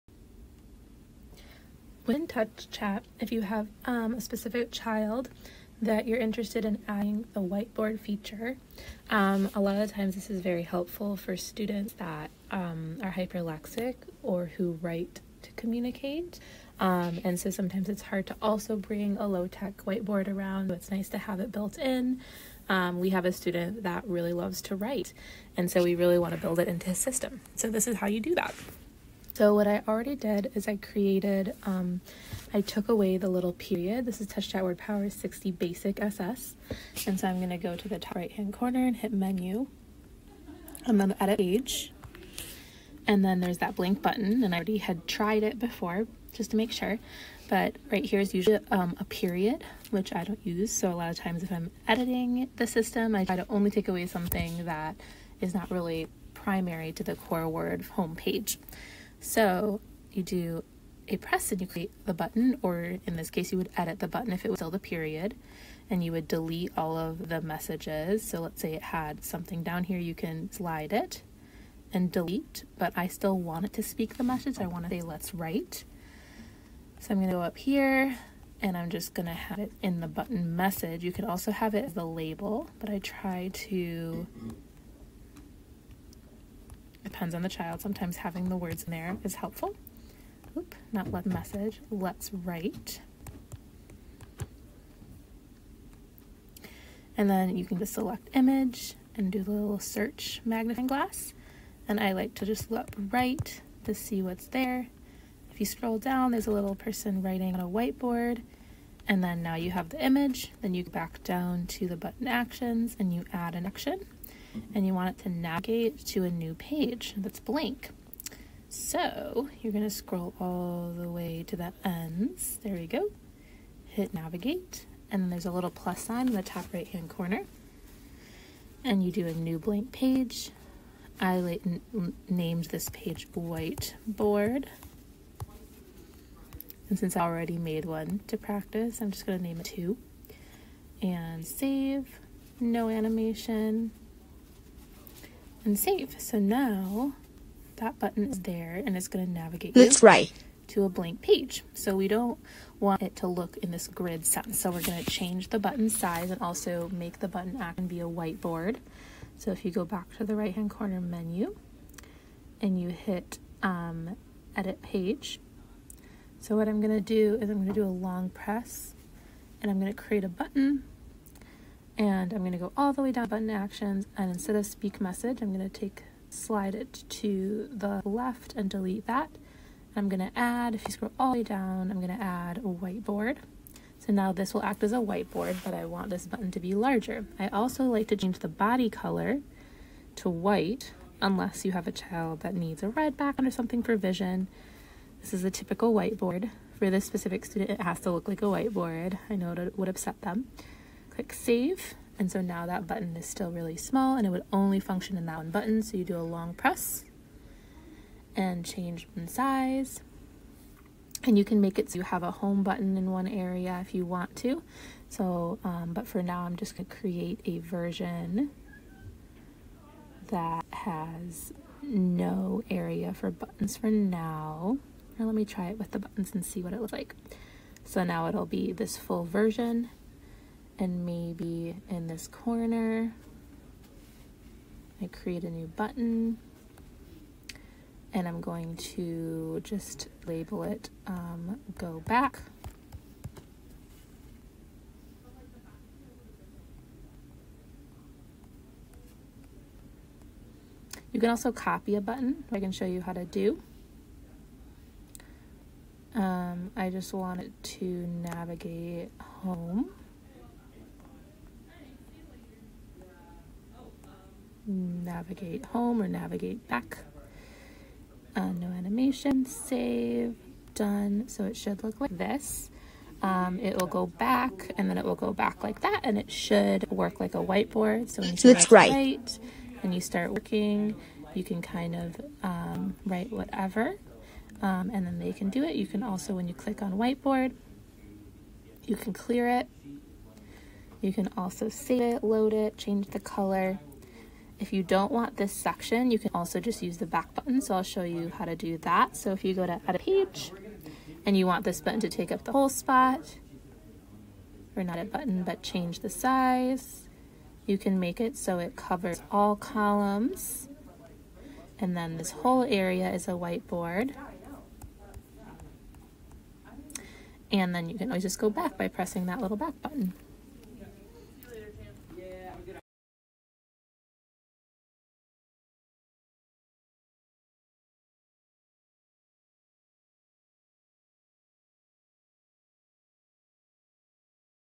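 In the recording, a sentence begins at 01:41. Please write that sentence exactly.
And I like to just look right to see what's there.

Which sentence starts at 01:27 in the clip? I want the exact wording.
Sometimes having the words in there is helpful.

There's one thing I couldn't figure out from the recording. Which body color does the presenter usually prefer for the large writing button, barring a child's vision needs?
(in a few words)
white.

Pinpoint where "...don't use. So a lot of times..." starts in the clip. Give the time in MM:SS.
00:50.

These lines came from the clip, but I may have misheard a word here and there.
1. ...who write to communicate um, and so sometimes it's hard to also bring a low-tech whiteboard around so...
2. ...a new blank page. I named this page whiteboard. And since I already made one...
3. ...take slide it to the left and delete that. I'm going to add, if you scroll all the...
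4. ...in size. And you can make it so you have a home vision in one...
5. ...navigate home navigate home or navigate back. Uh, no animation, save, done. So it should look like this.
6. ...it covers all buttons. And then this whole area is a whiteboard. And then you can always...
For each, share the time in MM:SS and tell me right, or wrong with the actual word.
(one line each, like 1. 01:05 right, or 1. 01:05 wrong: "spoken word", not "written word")
1. 00:14 right
2. 02:09 right
3. 02:55 right
4. 03:29 wrong: "button", not "vision"
5. 04:18 right
6. 05:08 wrong: "columns", not "buttons".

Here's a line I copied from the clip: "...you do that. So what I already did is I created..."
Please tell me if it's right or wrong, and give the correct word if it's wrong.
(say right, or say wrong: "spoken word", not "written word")
right.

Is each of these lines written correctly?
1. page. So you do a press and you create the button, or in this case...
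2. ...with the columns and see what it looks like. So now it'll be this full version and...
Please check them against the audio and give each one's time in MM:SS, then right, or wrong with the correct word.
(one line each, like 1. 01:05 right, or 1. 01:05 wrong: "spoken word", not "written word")
1. 00:58 right
2. 03:45 wrong: "buttons", not "columns".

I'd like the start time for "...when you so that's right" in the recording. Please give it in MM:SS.
04:38.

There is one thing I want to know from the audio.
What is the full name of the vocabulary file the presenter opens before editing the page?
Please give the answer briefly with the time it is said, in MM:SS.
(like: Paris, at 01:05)
Touch WordPower 60 Basic SS, at 00:34.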